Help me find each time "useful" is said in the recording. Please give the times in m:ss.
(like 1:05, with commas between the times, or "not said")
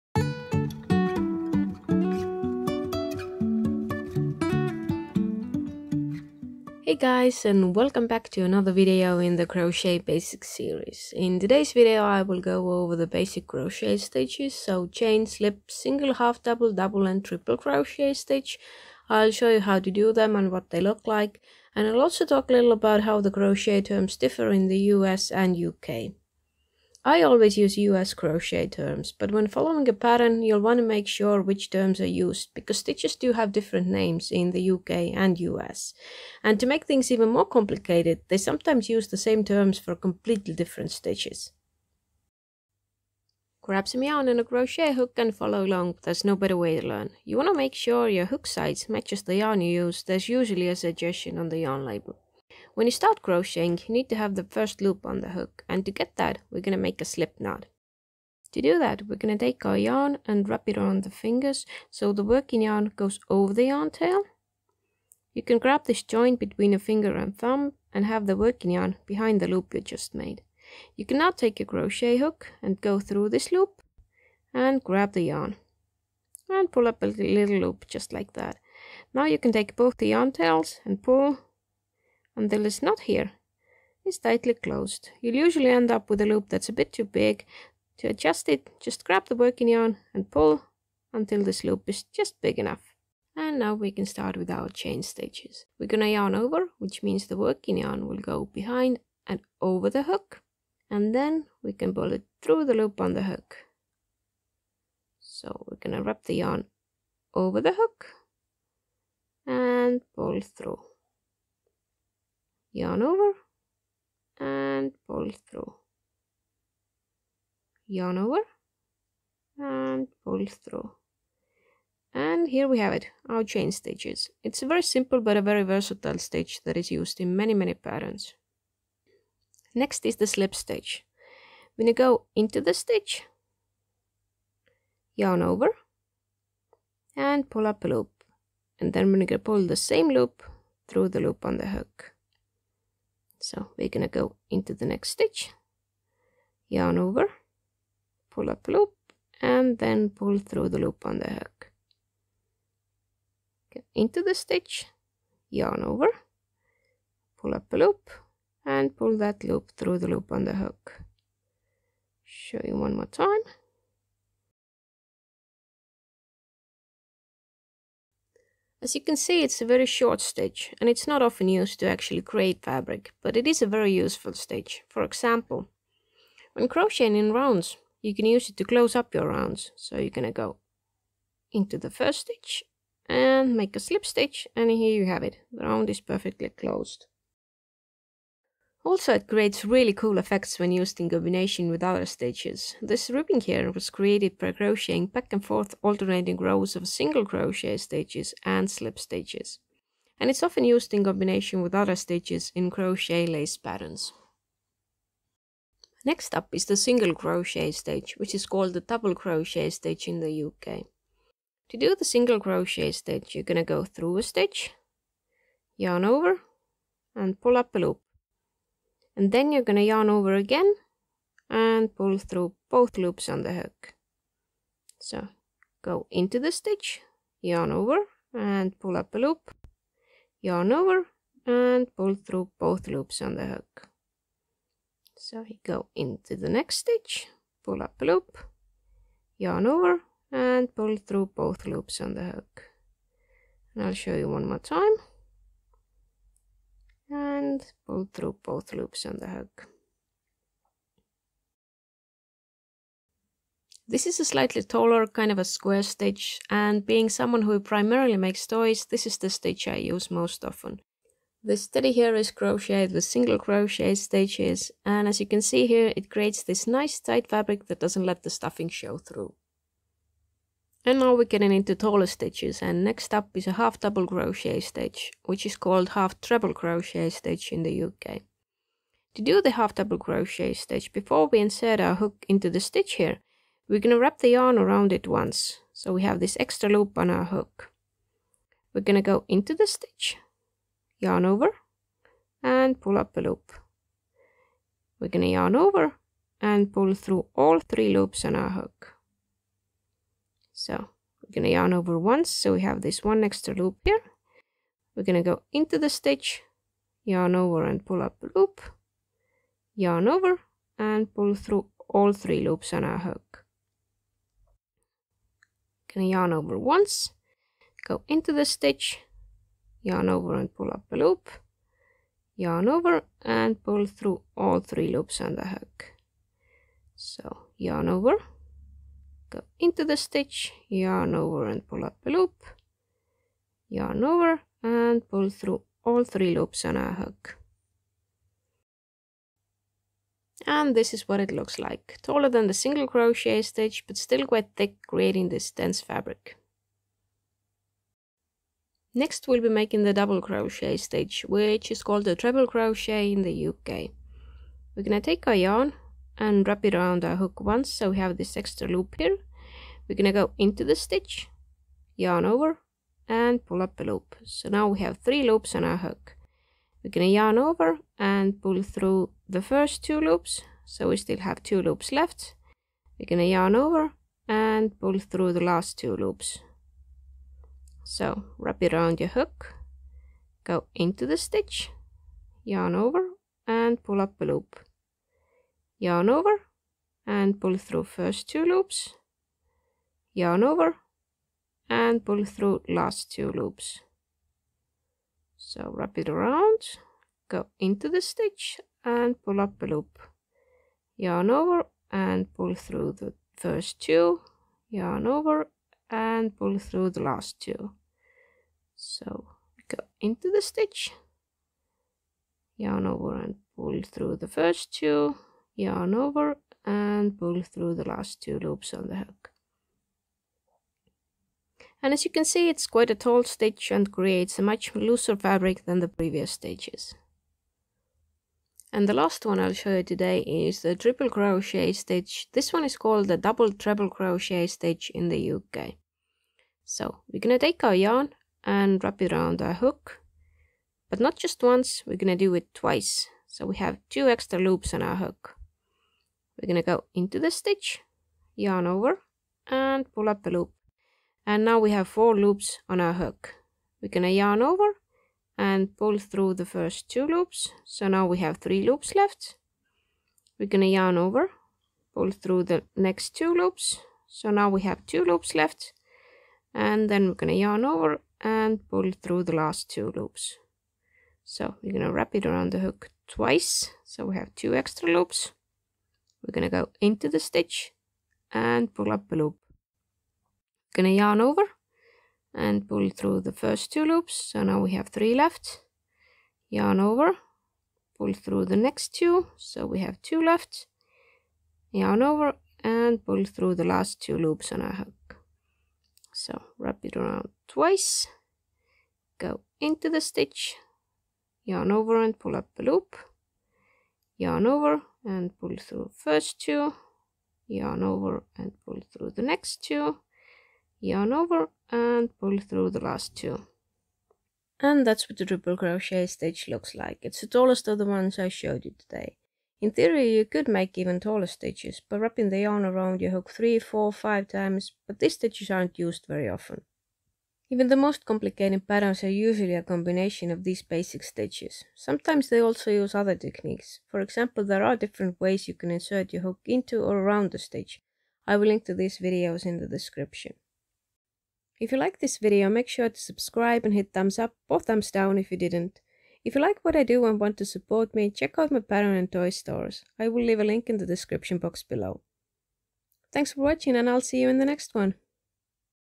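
2:53.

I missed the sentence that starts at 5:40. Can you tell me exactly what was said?
And this is what it looks like, taller than the single crochet stitch but still quite thick creating this dense fabric.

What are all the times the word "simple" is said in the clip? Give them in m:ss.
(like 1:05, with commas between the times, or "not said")
2:04.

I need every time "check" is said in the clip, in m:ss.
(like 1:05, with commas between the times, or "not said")
9:08.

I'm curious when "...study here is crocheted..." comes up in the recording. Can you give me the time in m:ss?
4:21.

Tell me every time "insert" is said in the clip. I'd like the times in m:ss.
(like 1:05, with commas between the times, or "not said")
4:41, 8:55.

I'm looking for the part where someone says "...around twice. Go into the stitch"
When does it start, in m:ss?
8:16.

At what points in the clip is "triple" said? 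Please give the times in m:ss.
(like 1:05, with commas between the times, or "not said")
0:17, 7:10, 8:35.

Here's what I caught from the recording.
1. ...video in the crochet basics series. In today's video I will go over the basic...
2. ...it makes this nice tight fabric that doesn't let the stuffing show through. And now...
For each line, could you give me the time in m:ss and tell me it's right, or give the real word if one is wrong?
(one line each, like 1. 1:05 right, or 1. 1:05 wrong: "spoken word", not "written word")
1. 0:08 right
2. 4:25 wrong: "creates", not "makes".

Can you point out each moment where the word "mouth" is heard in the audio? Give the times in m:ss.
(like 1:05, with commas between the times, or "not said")
not said.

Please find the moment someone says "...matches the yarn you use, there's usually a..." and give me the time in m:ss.
0:48.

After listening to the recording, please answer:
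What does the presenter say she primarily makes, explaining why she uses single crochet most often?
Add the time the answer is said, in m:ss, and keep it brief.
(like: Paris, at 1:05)
toys, at 4:18.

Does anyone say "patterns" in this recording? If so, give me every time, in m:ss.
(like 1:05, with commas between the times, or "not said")
0:29, 2:07, 3:23, 8:48, 9:08.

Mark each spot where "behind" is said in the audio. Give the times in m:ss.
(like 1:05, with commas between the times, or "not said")
1:09, 1:38.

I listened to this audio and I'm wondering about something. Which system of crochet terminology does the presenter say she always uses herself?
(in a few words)
US crochet terms.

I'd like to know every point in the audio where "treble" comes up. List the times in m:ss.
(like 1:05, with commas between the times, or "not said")
4:36, 5:52, 7:13.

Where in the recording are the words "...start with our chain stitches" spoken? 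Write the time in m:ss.
1:34.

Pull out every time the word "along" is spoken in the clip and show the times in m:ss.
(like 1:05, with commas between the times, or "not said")
0:45.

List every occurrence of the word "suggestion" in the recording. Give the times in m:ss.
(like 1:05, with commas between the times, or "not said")
0:50.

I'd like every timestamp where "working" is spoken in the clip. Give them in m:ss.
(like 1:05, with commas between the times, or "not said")
1:02, 1:08, 1:29, 1:37.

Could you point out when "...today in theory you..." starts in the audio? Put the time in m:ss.
8:38.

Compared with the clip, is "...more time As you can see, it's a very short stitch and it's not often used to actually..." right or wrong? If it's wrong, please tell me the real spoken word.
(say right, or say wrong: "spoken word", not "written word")
right.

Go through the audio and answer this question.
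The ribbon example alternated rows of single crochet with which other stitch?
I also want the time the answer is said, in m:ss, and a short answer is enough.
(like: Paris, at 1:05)
slip stitches, at 3:18.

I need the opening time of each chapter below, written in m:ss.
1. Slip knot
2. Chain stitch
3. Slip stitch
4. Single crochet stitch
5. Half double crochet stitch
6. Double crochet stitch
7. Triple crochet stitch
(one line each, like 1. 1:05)
1. 0:52
2. 1:33
3. 2:09
4. 3:24
5. 4:31
6. 5:48
7. 7:07.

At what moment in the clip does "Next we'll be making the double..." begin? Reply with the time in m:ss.
5:48.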